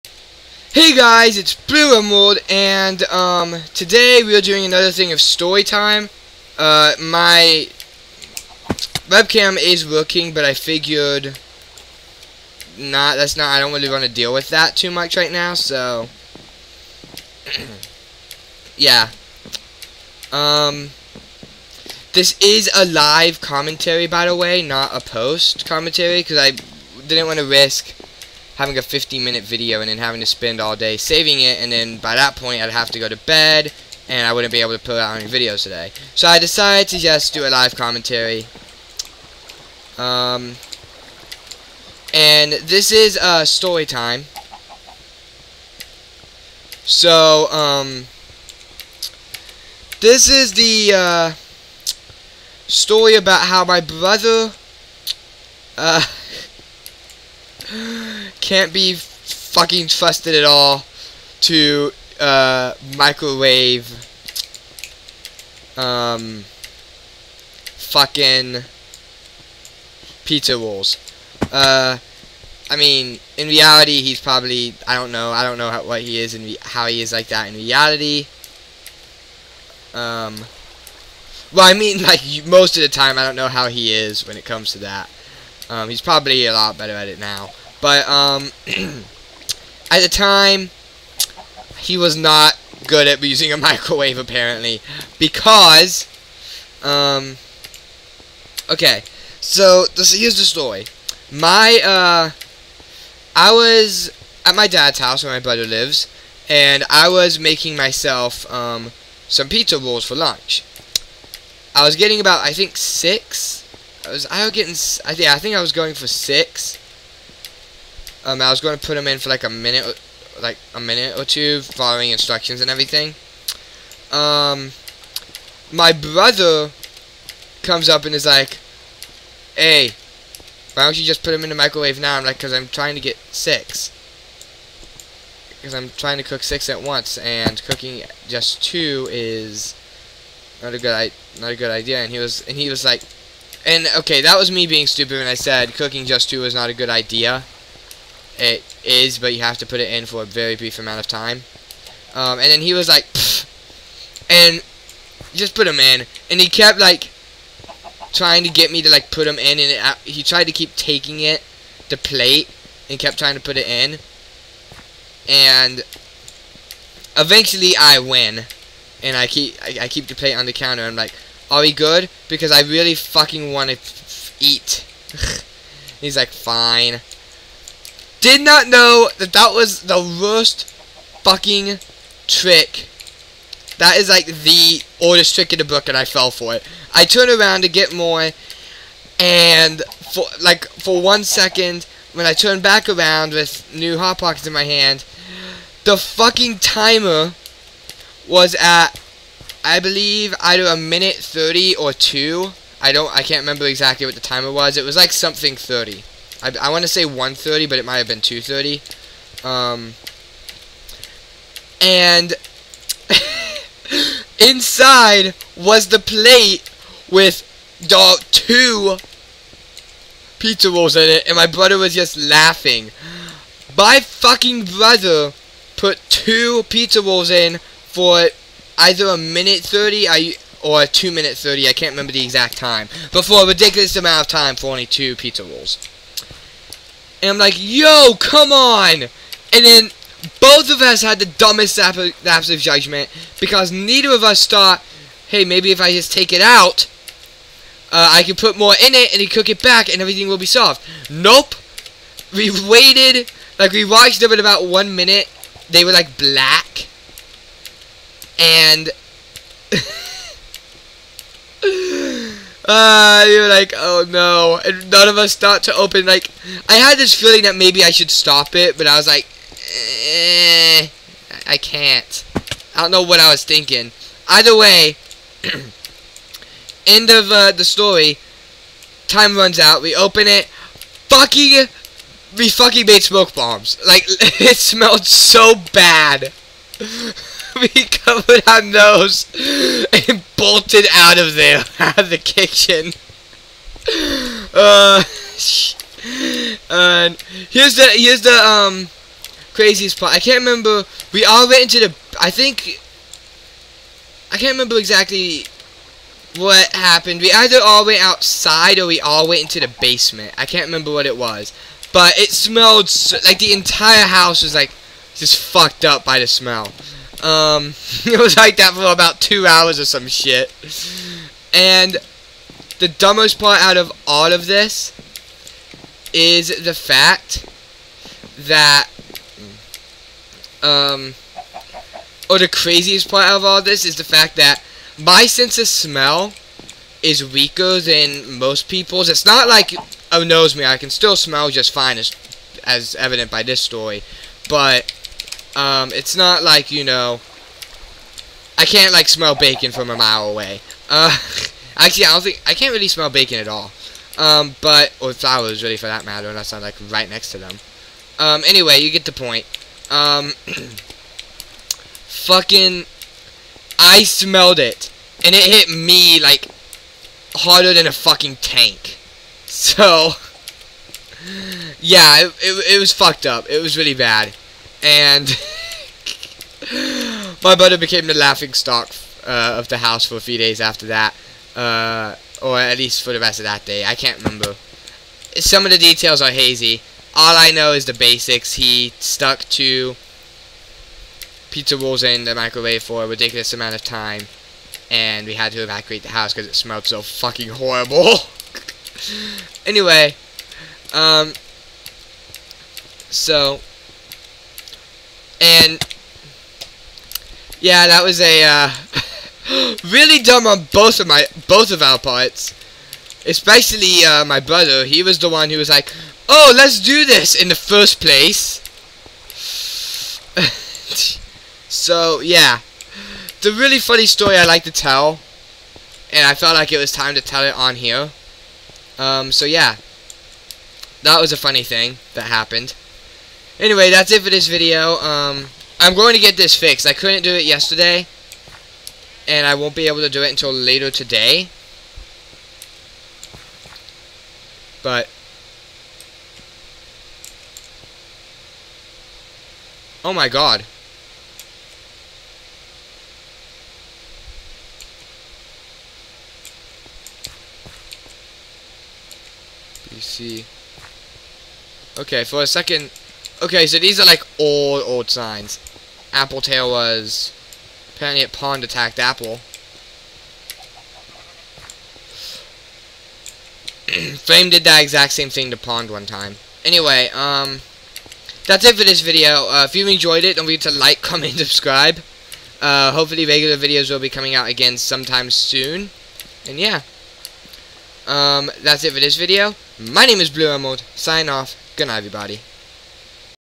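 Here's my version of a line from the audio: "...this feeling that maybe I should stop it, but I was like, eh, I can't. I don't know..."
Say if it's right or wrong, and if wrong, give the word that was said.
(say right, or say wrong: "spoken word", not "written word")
right.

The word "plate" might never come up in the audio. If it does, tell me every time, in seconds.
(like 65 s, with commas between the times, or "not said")
161 s, 170 s, 215 s.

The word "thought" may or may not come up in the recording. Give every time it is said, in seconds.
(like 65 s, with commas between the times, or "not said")
244 s, 265 s.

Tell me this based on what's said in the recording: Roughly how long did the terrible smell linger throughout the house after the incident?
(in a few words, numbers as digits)
about 2 hours.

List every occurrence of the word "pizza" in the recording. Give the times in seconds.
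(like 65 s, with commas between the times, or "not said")
70 s, 109 s, 220 s, 226 s, 235 s, 391 s.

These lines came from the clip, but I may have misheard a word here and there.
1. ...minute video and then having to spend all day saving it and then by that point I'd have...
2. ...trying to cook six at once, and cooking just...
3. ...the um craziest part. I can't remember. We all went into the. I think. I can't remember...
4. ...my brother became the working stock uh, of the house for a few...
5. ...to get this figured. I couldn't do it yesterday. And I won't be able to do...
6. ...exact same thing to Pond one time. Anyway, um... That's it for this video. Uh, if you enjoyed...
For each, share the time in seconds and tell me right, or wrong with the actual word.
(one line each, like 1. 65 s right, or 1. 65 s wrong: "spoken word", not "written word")
1. 29 s right
2. 135 s right
3. 298 s right
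4. 377 s wrong: "laughing", not "working"
5. 436 s wrong: "fixed", not "figured"
6. 474 s right.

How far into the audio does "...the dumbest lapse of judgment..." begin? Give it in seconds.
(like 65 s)
241 s.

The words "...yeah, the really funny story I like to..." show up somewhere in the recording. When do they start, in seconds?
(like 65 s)
422 s.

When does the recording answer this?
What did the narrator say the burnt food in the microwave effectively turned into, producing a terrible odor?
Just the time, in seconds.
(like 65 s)
283 s.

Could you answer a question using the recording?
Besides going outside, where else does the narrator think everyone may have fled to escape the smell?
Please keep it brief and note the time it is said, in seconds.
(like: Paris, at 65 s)
the basement, at 309 s.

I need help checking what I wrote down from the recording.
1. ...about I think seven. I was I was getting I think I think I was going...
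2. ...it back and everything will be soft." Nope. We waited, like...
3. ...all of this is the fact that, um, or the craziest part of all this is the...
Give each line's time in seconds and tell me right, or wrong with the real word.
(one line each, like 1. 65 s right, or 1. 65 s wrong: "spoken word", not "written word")
1. 112 s wrong: "six", not "seven"
2. 249 s right
3. 324 s right.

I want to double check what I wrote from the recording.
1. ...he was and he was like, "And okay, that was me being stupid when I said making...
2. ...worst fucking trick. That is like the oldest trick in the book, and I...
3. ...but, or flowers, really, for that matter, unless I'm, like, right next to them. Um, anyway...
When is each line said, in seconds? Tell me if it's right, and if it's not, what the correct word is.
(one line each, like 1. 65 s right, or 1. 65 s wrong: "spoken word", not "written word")
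1. 142 s wrong: "cooking", not "making"
2. 180 s right
3. 354 s right.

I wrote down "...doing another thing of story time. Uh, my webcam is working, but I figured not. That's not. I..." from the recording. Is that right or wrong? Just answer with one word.
right.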